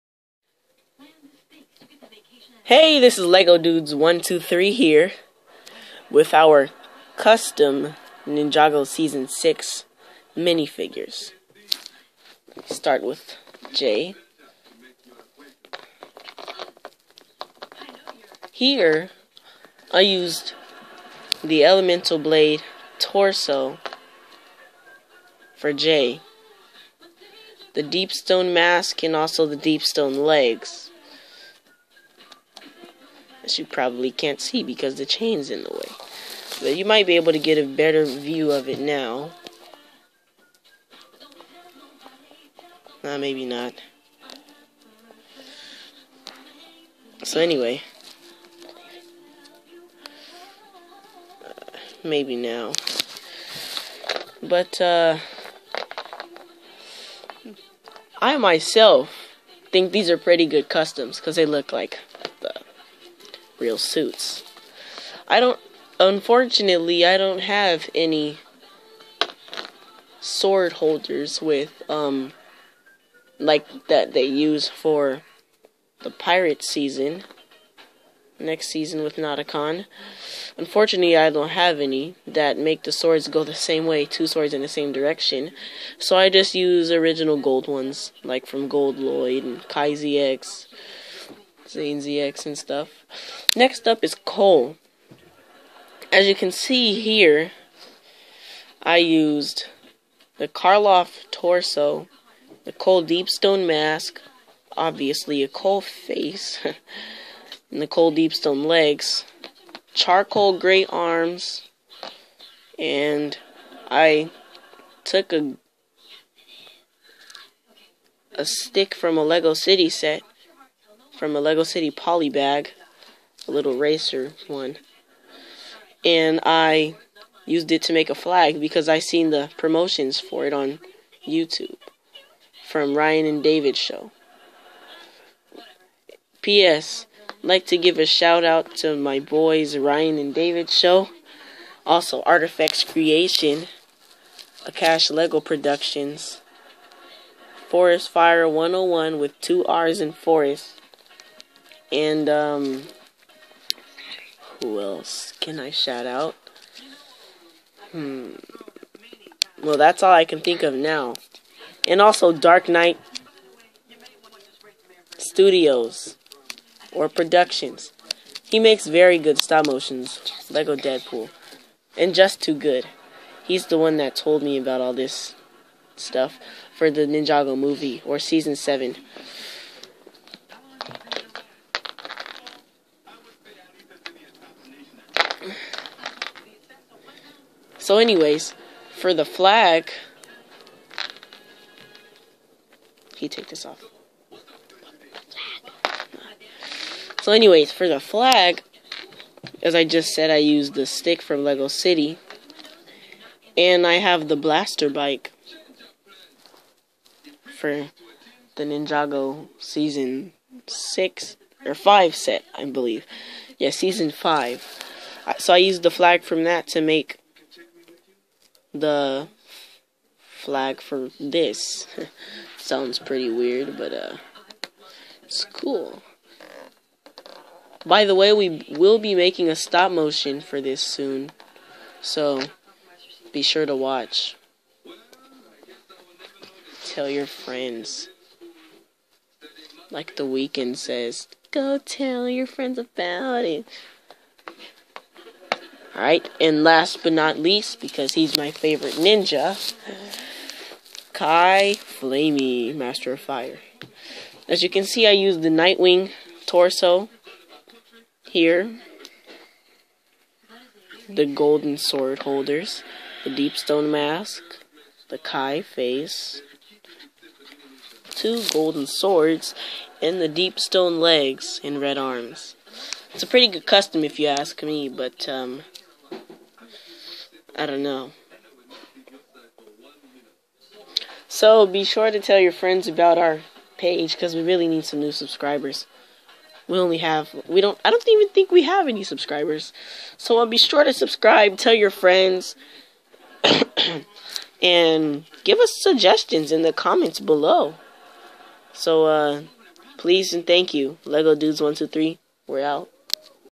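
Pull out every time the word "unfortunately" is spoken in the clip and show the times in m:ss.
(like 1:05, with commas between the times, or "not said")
1:05, 1:20.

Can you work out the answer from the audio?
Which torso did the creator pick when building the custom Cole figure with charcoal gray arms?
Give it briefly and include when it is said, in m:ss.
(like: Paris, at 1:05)
Karloff, at 1:40.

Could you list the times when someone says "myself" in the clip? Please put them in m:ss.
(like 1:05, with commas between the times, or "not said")
0:58.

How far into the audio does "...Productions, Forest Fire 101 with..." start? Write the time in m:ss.
2:25.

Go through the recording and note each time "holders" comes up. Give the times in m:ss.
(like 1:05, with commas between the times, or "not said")
1:10, 4:22.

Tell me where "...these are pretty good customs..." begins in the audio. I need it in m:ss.
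0:59.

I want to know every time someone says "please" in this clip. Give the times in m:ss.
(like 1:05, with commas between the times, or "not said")
4:59.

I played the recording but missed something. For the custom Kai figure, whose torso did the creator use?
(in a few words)
Nightwing.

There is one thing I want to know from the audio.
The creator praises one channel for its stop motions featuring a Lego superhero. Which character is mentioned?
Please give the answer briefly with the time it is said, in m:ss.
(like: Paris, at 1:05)
Deadpool, at 2:50.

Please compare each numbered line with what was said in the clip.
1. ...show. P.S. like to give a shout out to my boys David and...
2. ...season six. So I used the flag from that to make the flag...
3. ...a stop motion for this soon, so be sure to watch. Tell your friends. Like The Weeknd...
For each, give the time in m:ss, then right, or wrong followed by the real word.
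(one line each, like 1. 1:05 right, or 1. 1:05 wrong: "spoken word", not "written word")
1. 2:13 wrong: "Ryan", not "David"
2. 3:33 wrong: "five", not "six"
3. 3:49 right.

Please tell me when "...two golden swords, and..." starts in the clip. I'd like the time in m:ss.
4:28.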